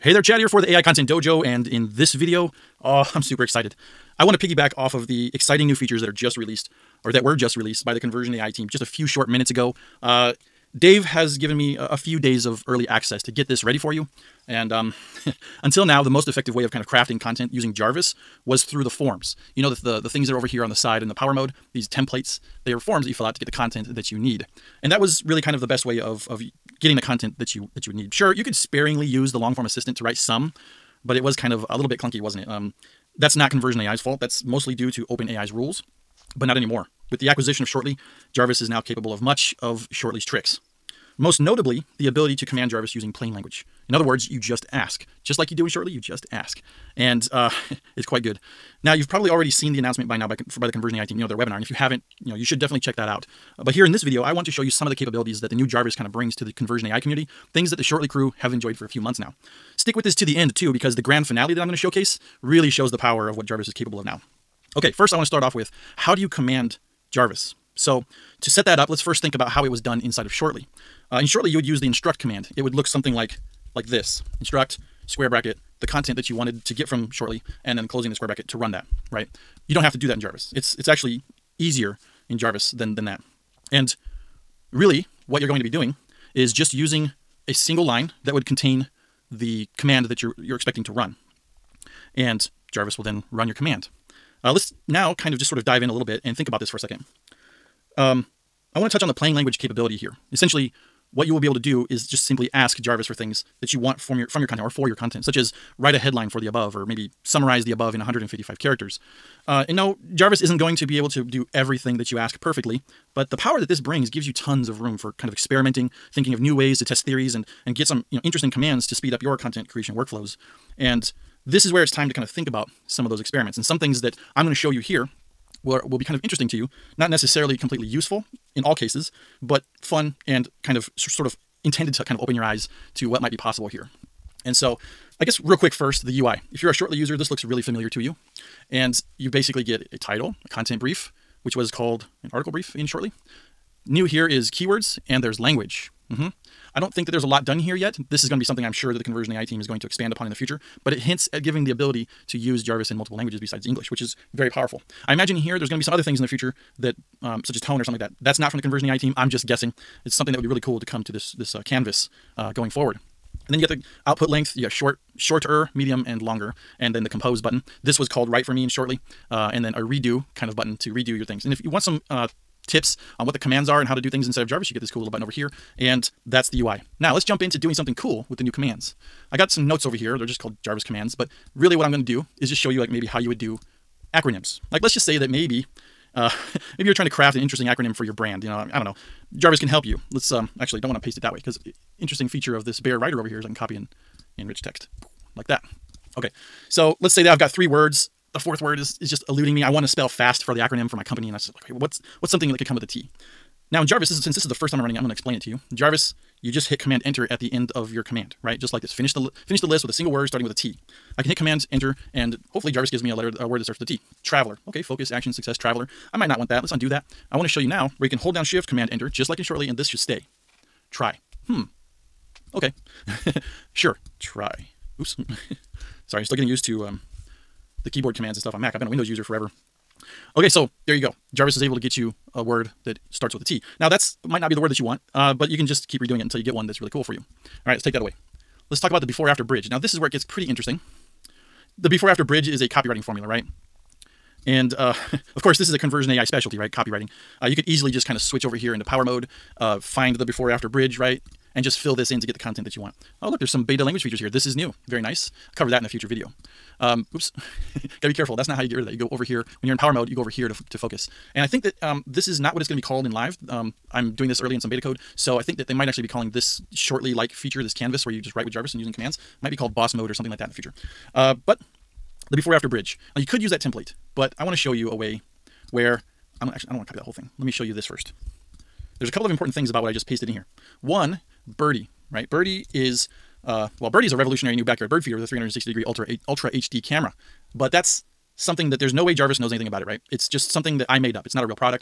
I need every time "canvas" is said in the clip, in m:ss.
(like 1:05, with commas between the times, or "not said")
2:41, 4:27.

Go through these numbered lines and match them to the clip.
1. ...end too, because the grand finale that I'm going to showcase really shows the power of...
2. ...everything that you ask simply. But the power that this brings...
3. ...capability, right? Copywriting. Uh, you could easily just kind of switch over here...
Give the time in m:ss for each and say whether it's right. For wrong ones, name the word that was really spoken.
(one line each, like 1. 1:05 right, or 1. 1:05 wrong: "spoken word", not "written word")
1. 1:00 right
2. 1:51 wrong: "perfectly", not "simply"
3. 4:06 wrong: "specialty", not "capability".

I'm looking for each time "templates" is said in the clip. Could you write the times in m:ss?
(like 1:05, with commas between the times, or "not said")
0:21, 4:33.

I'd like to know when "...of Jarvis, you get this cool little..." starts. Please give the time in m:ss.
2:54.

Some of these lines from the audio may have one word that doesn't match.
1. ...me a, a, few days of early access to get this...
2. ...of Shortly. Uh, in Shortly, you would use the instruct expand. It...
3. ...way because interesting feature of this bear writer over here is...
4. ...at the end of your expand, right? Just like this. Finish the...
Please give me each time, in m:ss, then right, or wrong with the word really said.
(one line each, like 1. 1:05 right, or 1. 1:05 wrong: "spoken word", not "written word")
1. 0:11 right
2. 1:10 wrong: "command", not "expand"
3. 3:11 right
4. 3:27 wrong: "command", not "expand".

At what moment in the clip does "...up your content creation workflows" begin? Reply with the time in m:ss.
1:59.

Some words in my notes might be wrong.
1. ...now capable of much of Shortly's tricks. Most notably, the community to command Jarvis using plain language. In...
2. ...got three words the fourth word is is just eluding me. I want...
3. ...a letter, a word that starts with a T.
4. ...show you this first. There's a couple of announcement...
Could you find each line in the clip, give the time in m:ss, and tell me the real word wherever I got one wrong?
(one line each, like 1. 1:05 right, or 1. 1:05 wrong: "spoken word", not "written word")
1. 0:38 wrong: "ability", not "community"
2. 3:17 right
3. 3:33 right
4. 4:37 wrong: "important", not "announcement".